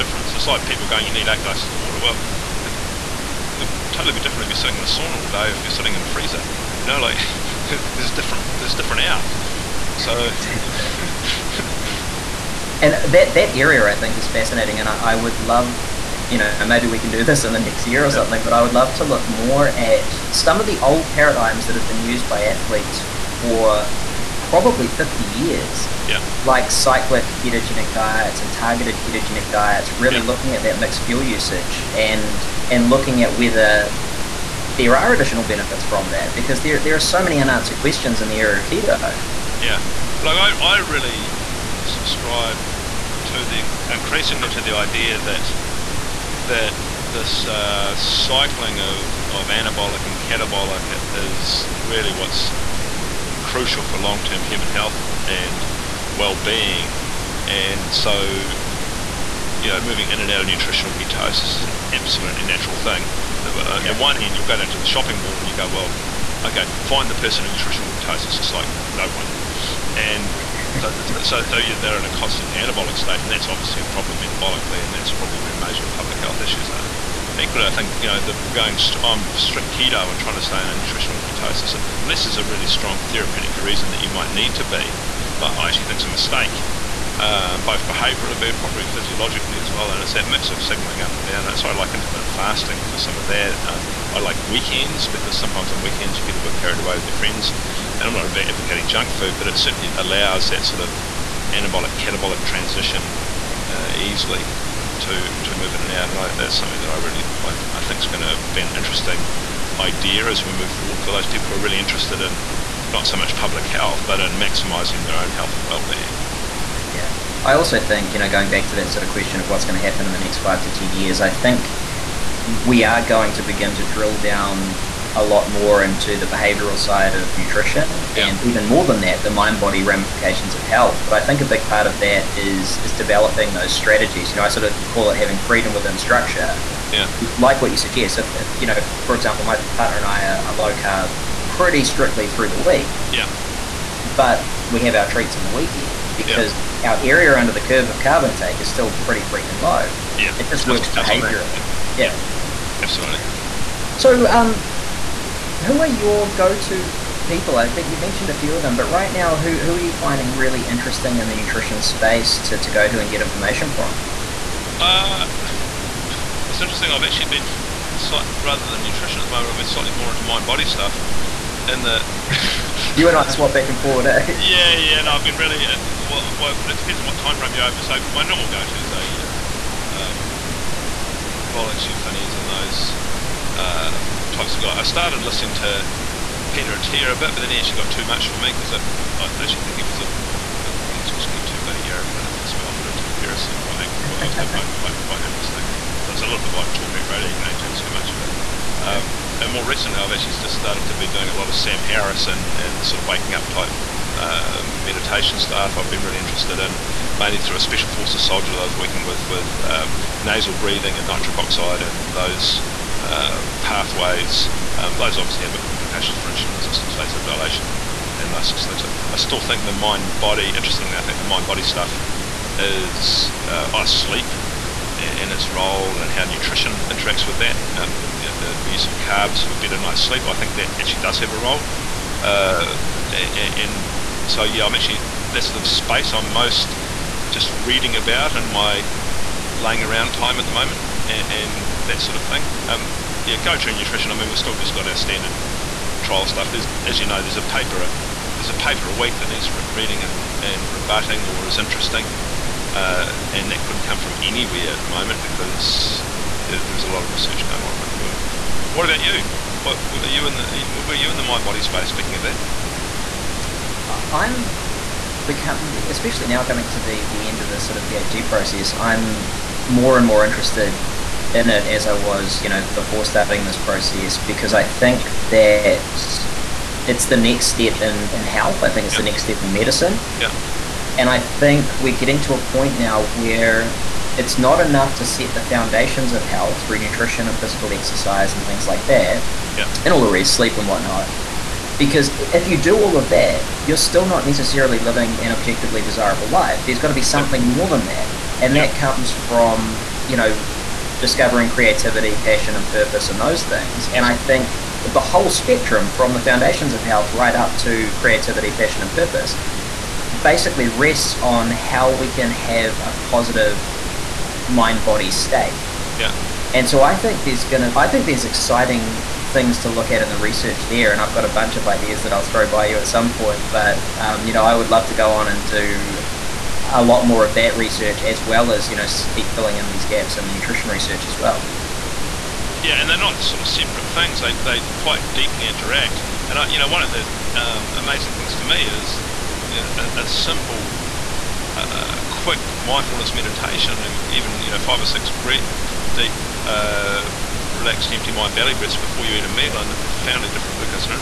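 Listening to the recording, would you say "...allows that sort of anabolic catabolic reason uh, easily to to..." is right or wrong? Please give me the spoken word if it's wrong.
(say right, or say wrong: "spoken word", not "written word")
wrong: "transition", not "reason".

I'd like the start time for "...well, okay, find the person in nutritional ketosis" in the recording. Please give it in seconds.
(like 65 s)
65 s.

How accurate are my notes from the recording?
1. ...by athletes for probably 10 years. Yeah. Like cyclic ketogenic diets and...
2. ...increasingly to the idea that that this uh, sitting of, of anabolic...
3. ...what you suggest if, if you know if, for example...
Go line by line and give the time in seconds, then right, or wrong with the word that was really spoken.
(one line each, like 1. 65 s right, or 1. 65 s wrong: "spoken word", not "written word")
1. 22 s wrong: "50", not "10"
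2. 43 s wrong: "cycling", not "sitting"
3. 137 s right.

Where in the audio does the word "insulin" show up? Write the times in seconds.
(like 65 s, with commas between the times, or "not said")
216 s.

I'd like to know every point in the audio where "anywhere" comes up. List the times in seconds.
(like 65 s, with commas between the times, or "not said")
254 s.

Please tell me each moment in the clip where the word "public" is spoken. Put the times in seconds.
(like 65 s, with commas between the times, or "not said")
75 s, 113 s.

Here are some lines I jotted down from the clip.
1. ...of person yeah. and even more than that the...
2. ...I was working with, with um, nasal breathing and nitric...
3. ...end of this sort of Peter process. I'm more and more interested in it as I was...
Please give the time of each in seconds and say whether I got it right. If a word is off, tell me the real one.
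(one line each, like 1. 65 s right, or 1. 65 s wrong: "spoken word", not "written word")
1. 127 s wrong: "nutrition", not "person"
2. 208 s right
3. 267 s wrong: "PhD", not "Peter".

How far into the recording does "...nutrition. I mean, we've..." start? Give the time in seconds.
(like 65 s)
243 s.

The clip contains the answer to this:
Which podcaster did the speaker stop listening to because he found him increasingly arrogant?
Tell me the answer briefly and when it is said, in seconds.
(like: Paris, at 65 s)
Peter Attia, at 186 s.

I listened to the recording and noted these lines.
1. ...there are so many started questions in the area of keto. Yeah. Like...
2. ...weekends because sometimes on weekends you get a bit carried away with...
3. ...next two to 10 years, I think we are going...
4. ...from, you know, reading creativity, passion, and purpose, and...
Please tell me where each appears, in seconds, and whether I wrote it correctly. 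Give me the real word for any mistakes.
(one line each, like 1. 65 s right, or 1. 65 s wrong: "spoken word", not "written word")
1. 36 s wrong: "unanswered", not "started"
2. 94 s right
3. 120 s wrong: "five", not "two"
4. 299 s wrong: "discovering", not "reading".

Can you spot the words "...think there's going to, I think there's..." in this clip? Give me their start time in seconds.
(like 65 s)
316 s.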